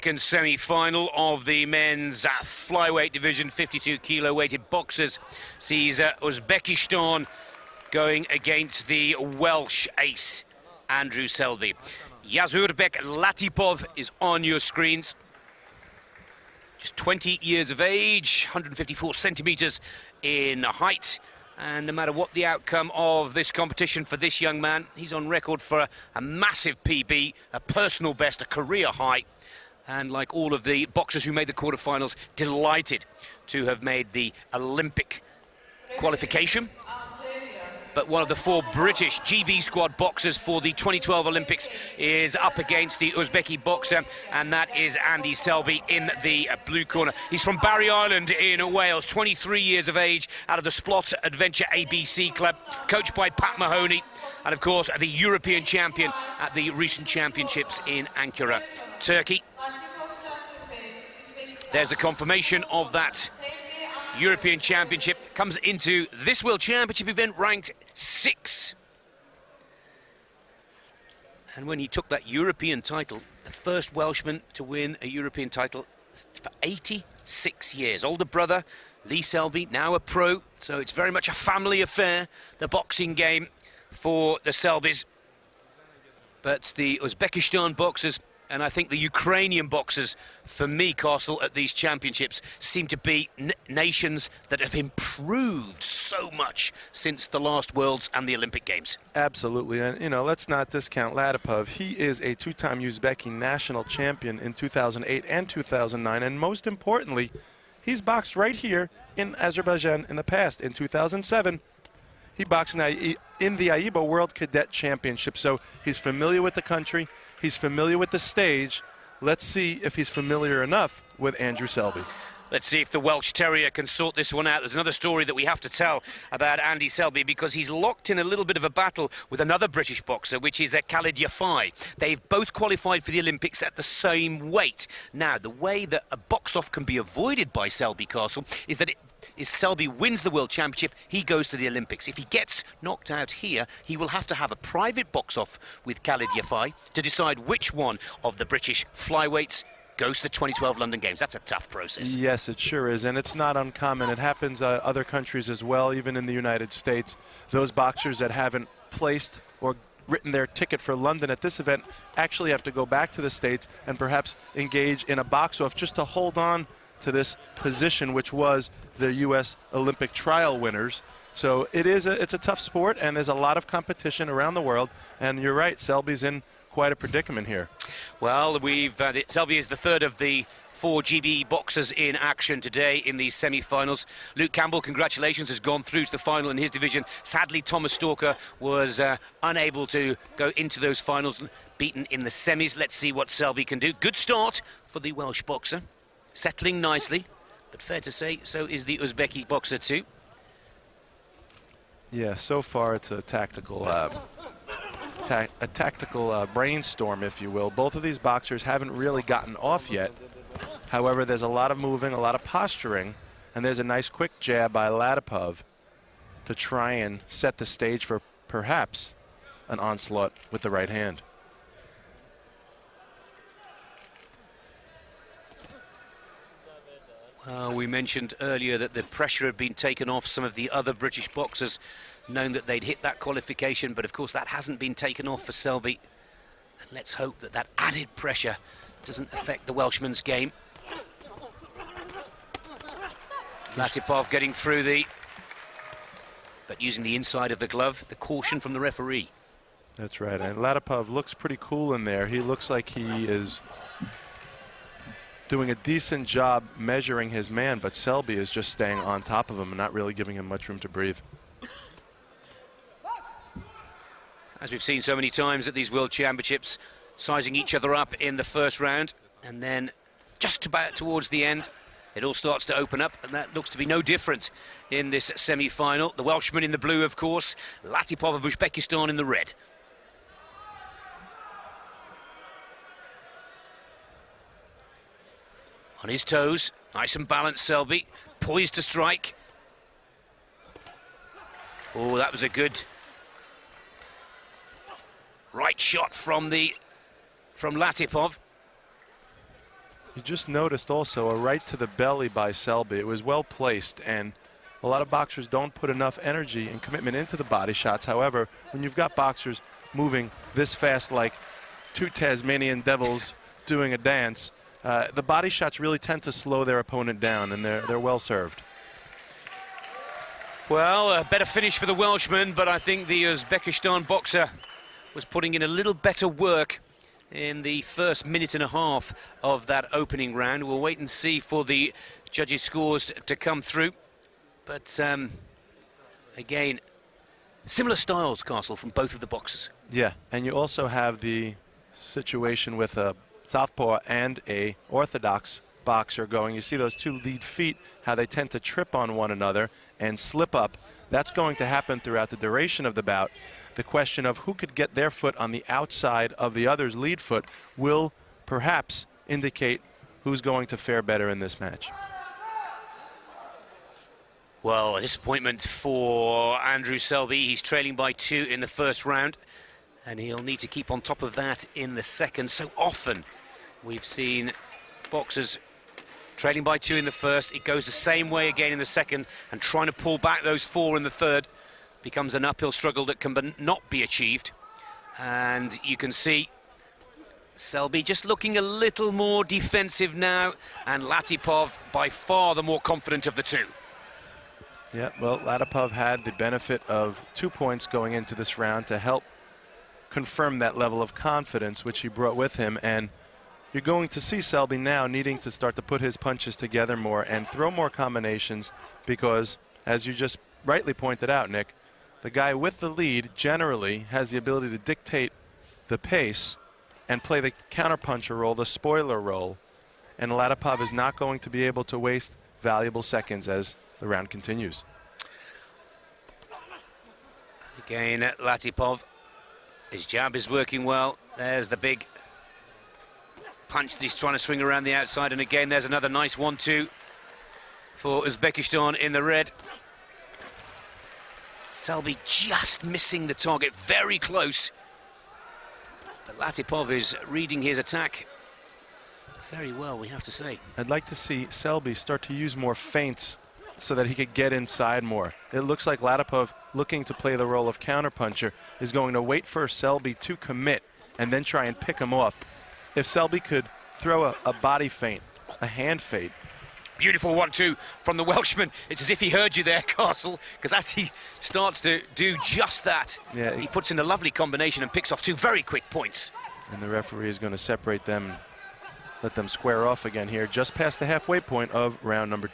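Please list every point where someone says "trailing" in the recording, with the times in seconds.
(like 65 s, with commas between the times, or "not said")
367 s, 376 s.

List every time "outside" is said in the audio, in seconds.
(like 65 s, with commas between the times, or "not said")
355 s, 434 s.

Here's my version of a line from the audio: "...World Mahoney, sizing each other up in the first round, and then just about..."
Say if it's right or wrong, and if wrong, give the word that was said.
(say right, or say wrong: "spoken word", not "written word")
wrong: "Championships", not "Mahoney".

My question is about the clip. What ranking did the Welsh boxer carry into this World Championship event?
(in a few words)
6.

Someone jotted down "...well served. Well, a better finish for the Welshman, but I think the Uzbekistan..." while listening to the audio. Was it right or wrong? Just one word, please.
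right.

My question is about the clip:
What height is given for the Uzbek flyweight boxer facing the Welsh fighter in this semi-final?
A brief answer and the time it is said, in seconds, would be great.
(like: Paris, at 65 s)
154 centimeters, at 18 s.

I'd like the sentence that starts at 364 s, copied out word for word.
Well, a disappointment for Andrew Selby.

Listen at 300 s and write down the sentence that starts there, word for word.
You just noticed also a right to the belly by Selby.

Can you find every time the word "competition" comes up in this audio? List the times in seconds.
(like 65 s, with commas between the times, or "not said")
23 s, 173 s.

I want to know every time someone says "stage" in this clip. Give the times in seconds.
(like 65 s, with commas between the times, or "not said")
118 s, 217 s.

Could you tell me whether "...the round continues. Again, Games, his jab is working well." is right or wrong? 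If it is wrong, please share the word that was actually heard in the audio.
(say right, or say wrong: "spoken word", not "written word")
wrong: "Latipov", not "Games".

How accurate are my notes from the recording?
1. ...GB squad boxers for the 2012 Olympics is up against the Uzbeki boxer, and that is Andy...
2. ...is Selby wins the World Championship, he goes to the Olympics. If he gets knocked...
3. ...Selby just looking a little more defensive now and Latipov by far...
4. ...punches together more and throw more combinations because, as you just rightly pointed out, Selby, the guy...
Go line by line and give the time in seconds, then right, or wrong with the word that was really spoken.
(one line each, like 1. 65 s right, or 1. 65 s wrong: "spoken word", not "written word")
1. 39 s right
2. 139 s right
3. 387 s right
4. 406 s wrong: "Nick", not "Selby".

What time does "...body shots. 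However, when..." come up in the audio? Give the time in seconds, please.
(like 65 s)
307 s.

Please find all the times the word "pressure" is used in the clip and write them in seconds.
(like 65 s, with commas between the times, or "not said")
229 s, 238 s.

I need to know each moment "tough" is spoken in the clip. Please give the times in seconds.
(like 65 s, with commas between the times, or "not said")
151 s, 172 s.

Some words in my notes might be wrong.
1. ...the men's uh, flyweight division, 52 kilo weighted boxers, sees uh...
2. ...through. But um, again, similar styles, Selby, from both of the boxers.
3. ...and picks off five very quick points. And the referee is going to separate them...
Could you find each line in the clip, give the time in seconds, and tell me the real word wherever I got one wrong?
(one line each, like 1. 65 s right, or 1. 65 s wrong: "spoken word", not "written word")
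1. 1 s right
2. 333 s wrong: "Castle", not "Selby"
3. 474 s wrong: "two", not "five".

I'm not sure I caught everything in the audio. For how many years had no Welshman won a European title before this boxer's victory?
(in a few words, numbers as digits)
86.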